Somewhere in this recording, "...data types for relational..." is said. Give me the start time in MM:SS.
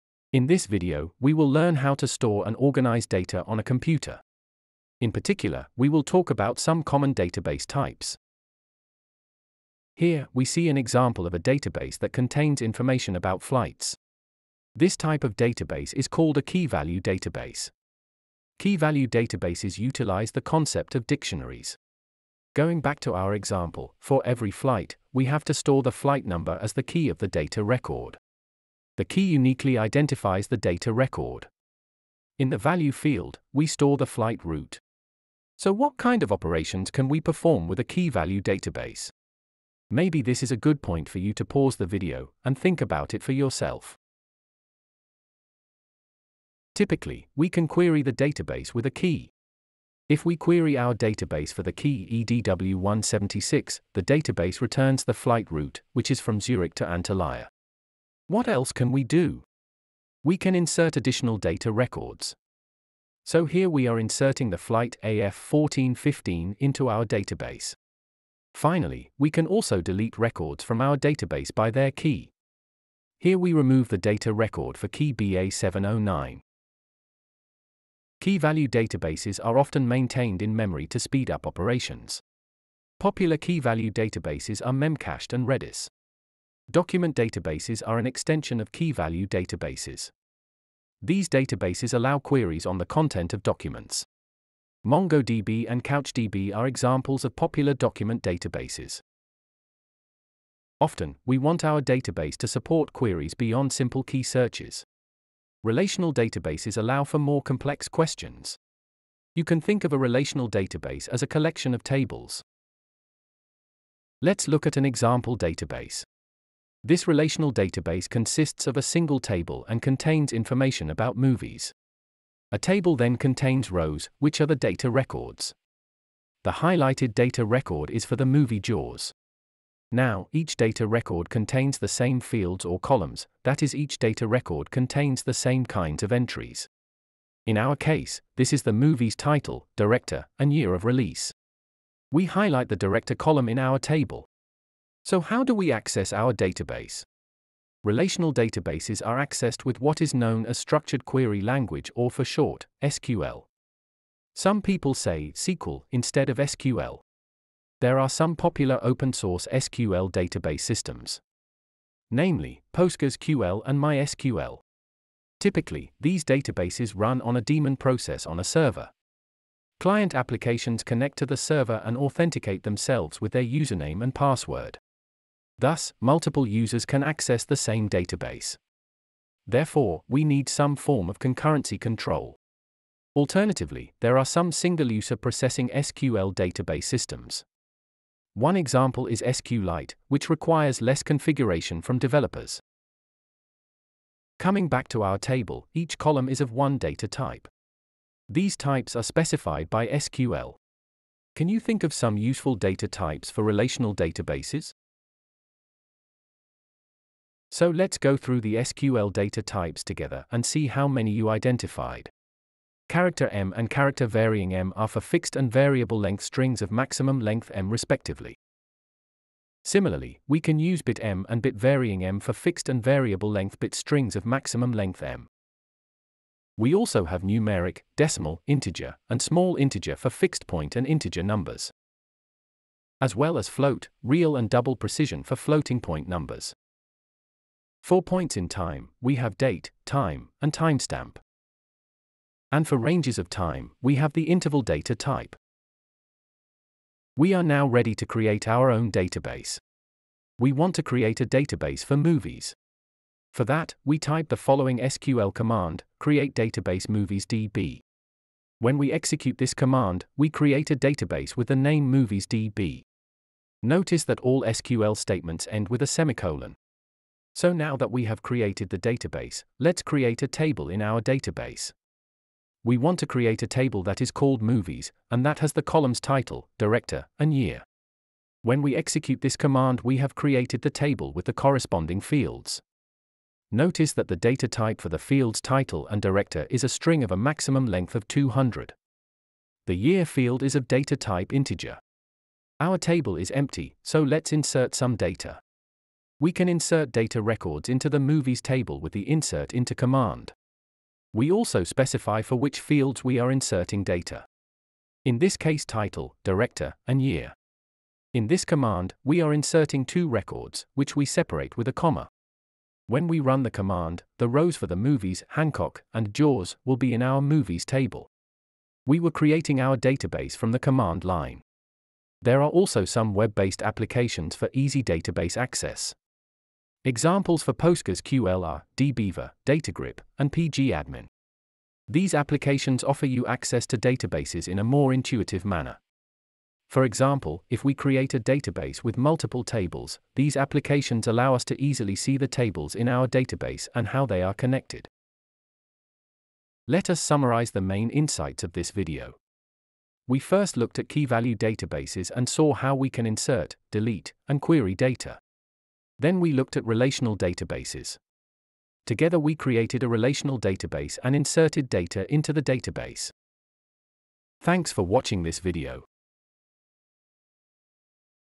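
03:22.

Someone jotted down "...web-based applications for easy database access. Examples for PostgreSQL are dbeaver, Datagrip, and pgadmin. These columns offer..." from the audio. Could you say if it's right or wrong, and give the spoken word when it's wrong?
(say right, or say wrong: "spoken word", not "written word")
wrong: "applications", not "columns".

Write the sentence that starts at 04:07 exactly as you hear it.
We are now ready to create our own database.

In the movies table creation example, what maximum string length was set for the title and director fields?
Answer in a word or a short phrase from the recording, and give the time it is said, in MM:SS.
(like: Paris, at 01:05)
200, at 04:48.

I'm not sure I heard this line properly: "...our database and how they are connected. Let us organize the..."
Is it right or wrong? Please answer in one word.
wrong.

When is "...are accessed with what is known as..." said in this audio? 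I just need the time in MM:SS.
02:29.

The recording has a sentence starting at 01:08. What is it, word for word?
Finally, we can also delete records from our database by their key.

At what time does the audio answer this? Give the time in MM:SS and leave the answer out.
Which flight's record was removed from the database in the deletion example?
01:15.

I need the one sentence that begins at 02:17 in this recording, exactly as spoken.
In our case, this is the movie's title, director, and year of release.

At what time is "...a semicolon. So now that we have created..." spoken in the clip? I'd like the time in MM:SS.
04:25.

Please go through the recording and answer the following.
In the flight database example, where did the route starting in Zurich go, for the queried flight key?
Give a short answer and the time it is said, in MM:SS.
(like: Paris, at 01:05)
Antalya, at 00:56.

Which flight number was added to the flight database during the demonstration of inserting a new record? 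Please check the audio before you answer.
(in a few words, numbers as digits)
AF1415.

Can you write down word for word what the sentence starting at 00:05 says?
In particular, we will talk about some common database types.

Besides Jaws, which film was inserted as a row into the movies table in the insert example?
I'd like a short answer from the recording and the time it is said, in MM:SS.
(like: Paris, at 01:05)
Hancock, at 05:15.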